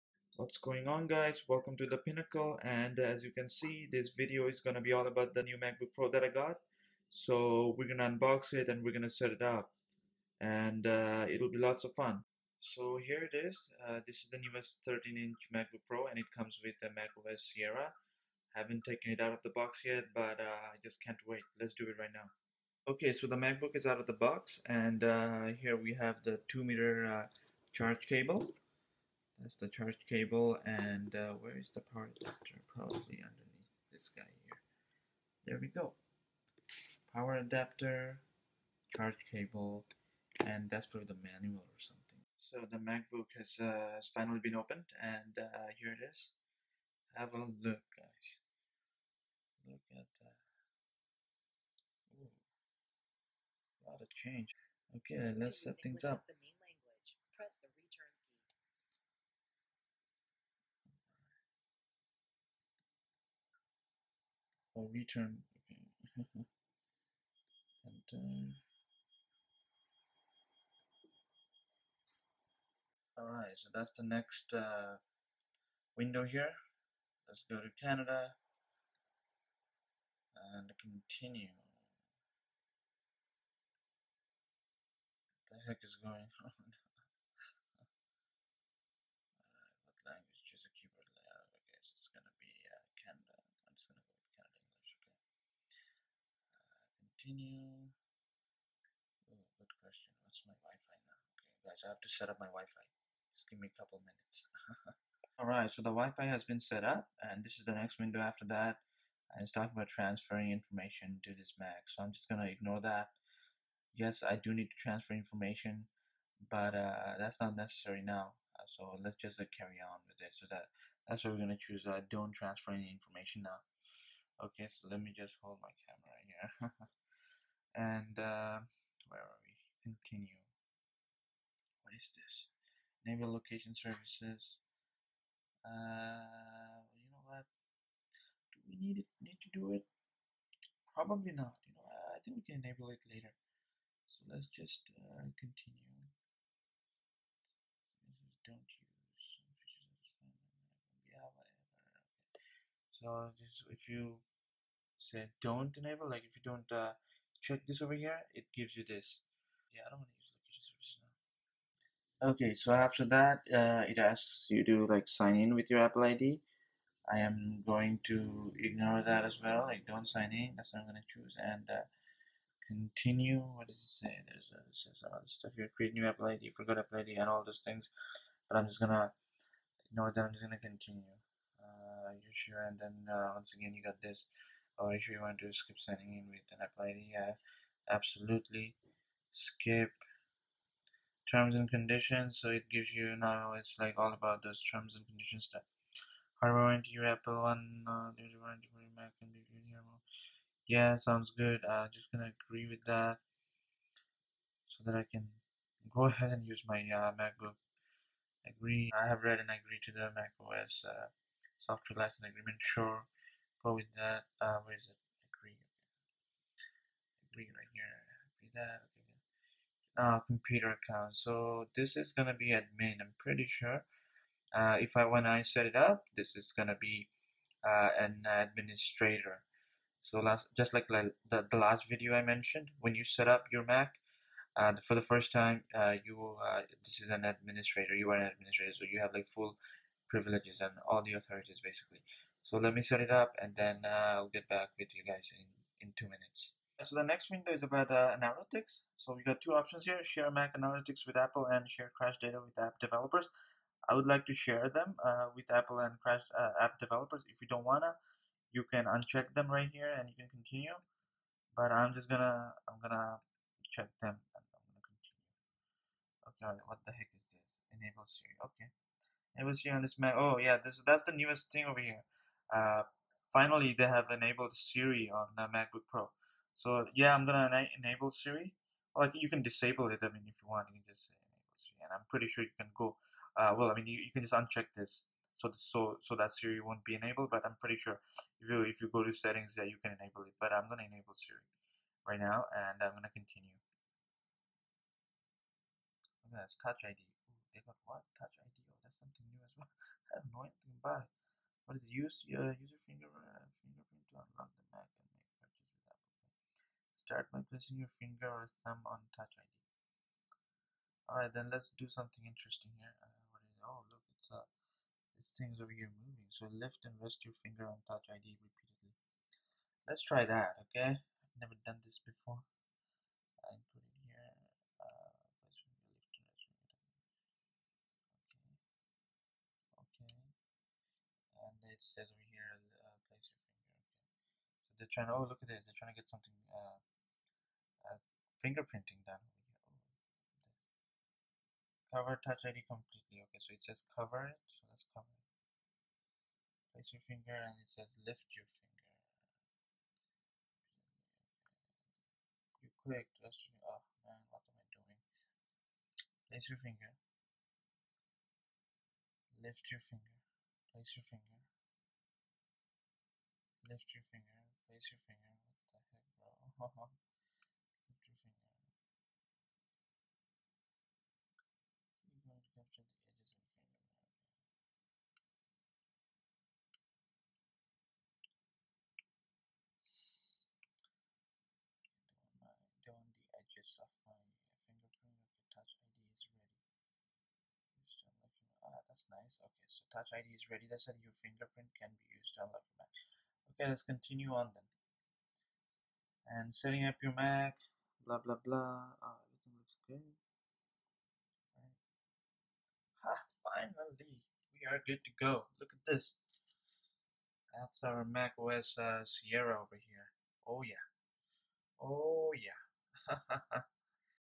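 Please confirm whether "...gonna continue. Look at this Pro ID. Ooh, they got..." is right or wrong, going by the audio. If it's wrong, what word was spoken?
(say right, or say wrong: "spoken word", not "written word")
wrong: "Touch", not "Pro".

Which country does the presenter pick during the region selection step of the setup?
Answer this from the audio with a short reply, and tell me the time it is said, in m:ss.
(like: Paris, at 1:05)
Canada, at 1:17.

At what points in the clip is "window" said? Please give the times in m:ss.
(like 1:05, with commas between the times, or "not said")
1:15, 1:47, 4:07.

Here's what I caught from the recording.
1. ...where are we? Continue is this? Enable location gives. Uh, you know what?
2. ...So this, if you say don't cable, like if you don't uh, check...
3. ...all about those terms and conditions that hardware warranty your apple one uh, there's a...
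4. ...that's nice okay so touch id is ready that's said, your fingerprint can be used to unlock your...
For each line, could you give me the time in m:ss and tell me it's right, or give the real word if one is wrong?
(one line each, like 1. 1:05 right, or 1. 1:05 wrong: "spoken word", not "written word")
1. 2:09 wrong: "services", not "gives"
2. 2:32 wrong: "enable", not "cable"
3. 3:13 right
4. 6:28 right.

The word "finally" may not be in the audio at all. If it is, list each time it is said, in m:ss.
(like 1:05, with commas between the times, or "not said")
0:44, 4:33, 6:43.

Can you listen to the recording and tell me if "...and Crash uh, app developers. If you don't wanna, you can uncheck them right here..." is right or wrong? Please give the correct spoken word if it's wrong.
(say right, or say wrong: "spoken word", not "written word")
right.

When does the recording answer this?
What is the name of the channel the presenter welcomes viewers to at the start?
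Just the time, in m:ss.
0:01.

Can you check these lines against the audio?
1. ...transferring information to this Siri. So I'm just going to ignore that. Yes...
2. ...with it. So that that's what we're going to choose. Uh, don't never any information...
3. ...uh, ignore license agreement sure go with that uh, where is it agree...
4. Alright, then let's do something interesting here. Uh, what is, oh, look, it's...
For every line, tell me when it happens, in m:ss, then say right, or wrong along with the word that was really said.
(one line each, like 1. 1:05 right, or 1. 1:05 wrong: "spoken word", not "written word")
1. 1:49 wrong: "Mac", not "Siri"
2. 2:00 wrong: "transfer", not "never"
3. 3:30 wrong: "software", not "ignore"
4. 5:11 right.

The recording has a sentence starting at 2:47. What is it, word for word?
I am going to ignore that as well.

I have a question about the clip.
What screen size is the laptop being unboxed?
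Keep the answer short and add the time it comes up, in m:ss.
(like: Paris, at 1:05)
13 inch, at 0:14.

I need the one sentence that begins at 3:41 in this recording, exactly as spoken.
So this is gonna be admin, I'm pretty sure.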